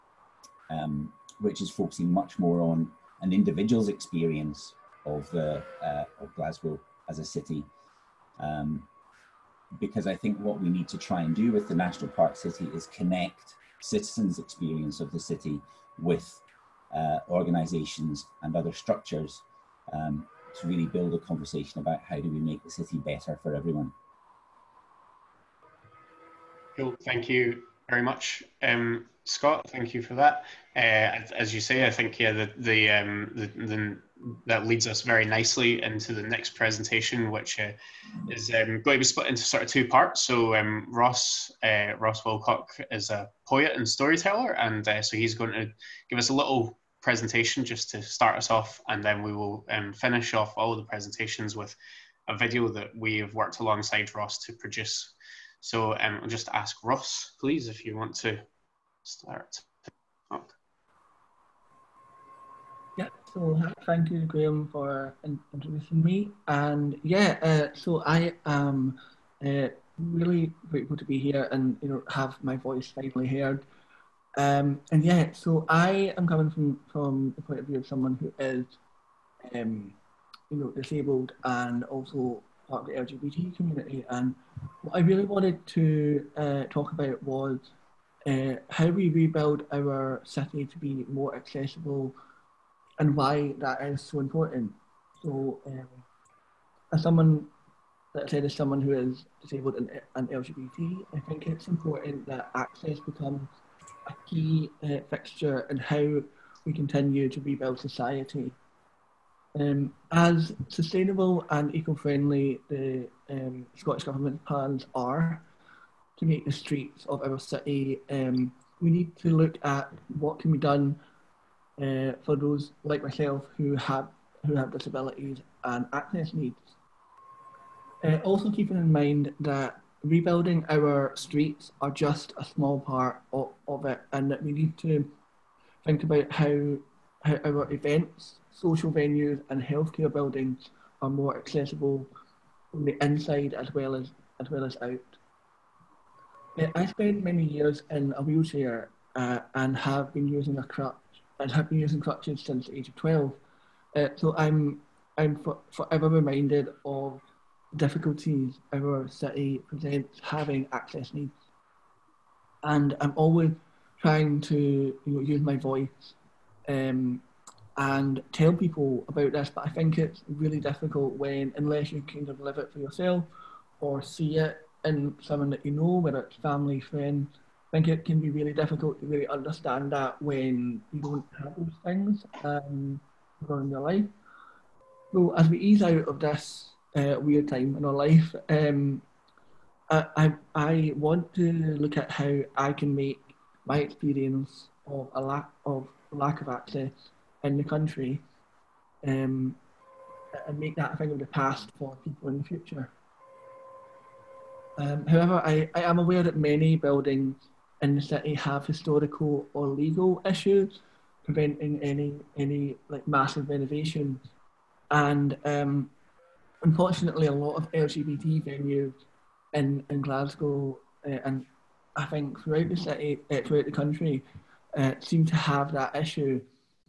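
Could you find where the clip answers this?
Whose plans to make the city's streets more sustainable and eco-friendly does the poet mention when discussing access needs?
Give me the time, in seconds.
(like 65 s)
113 s.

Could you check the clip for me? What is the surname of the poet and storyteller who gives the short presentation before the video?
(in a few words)
Wilcock.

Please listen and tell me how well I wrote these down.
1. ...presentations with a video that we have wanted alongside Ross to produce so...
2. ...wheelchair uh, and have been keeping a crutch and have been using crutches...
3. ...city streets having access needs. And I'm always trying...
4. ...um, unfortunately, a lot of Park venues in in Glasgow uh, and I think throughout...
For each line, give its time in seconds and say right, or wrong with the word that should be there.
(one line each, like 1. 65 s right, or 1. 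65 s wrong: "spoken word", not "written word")
1. 50 s wrong: "worked", not "wanted"
2. 148 s wrong: "using", not "keeping"
3. 159 s wrong: "presents", not "streets"
4. 215 s wrong: "LGBT", not "Park".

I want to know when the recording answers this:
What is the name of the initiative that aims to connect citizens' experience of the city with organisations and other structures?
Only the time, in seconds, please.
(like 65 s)
11 s.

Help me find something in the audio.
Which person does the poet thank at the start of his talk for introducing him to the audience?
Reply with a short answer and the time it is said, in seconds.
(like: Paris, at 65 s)
Graham, at 64 s.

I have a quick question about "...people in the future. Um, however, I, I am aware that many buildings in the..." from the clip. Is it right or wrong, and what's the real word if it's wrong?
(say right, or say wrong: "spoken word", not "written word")
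right.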